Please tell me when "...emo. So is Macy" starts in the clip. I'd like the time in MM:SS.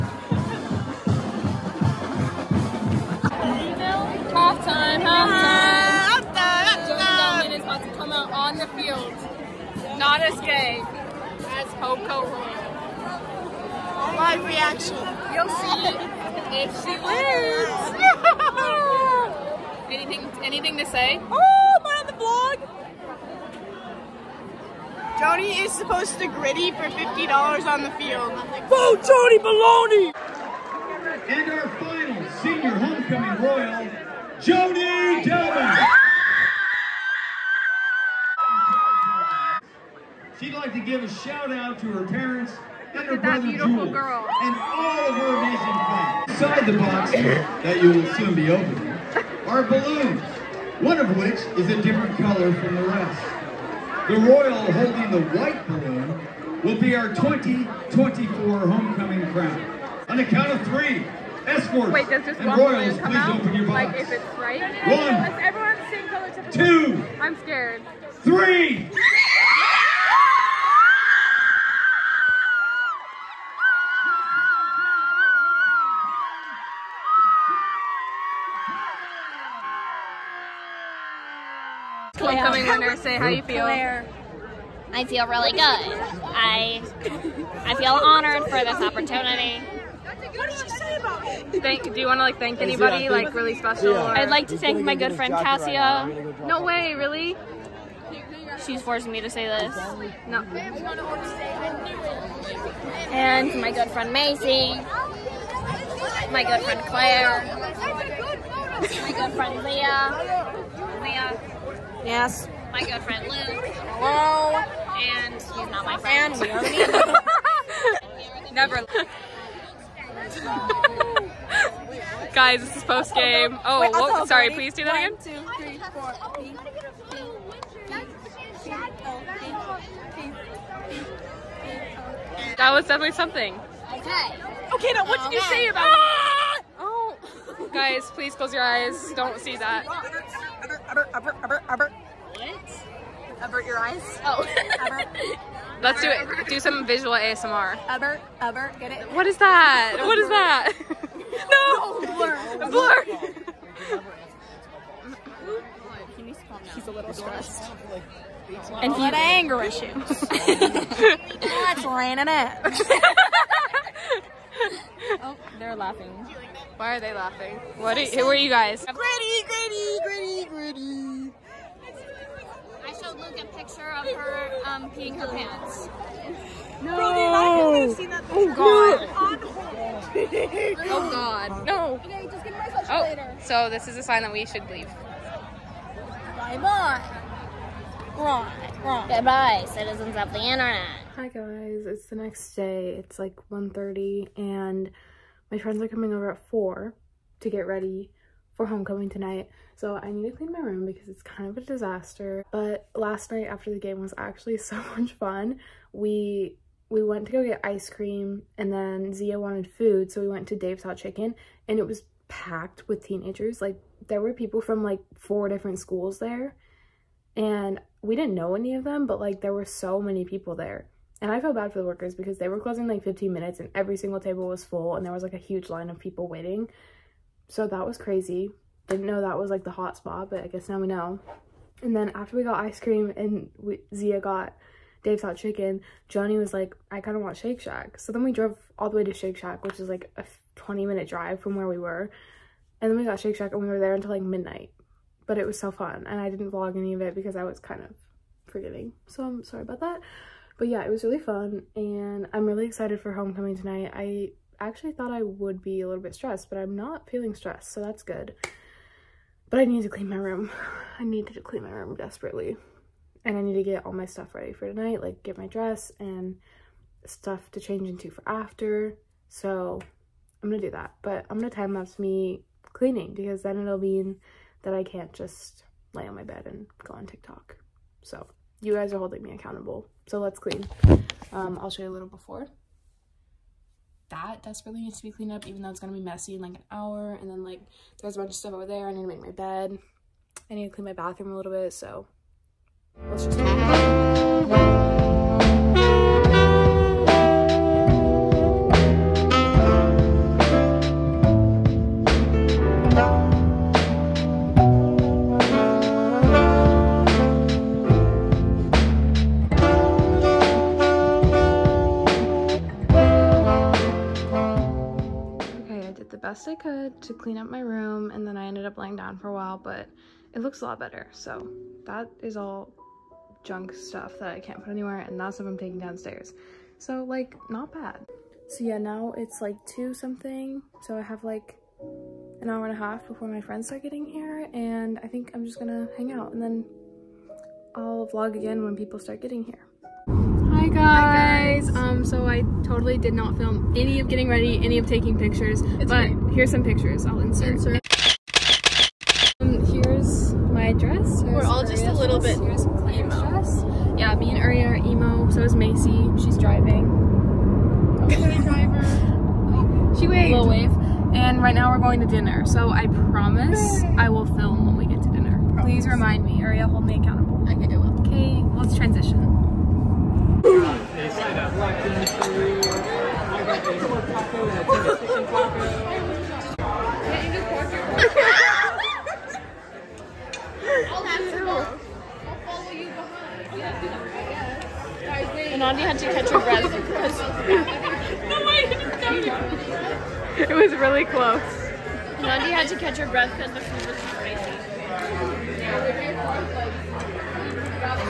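05:54.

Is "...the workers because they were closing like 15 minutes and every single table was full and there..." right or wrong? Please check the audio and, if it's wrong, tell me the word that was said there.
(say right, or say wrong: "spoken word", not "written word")
right.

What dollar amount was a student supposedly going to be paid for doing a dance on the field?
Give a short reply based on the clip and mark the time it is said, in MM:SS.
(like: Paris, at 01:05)
$50, at 00:26.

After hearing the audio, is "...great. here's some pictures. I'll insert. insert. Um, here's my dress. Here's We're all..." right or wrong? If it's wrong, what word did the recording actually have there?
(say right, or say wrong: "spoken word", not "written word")
right.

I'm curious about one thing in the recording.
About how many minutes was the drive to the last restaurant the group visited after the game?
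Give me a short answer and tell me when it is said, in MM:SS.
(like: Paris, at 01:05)
20, at 04:00.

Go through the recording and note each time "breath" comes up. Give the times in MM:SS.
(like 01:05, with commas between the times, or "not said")
06:26, 06:33.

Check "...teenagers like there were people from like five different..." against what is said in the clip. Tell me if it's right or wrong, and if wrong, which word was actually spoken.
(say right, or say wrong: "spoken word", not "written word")
wrong: "four", not "five".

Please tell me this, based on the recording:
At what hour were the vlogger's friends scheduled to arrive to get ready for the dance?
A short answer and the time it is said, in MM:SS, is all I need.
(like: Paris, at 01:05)
4, at 03:16.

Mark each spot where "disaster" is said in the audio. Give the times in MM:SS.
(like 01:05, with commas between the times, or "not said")
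03:21.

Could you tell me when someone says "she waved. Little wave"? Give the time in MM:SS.
05:59.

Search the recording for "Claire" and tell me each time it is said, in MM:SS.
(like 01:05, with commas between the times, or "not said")
01:23, 01:46.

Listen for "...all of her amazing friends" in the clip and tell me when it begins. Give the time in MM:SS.
00:44.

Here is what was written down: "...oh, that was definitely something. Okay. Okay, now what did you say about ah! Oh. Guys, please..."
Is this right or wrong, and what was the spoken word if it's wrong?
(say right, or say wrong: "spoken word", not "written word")
right.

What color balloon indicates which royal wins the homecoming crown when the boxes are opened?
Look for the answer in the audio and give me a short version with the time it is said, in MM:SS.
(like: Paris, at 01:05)
White, at 00:55.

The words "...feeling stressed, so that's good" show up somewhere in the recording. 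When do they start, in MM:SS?
04:17.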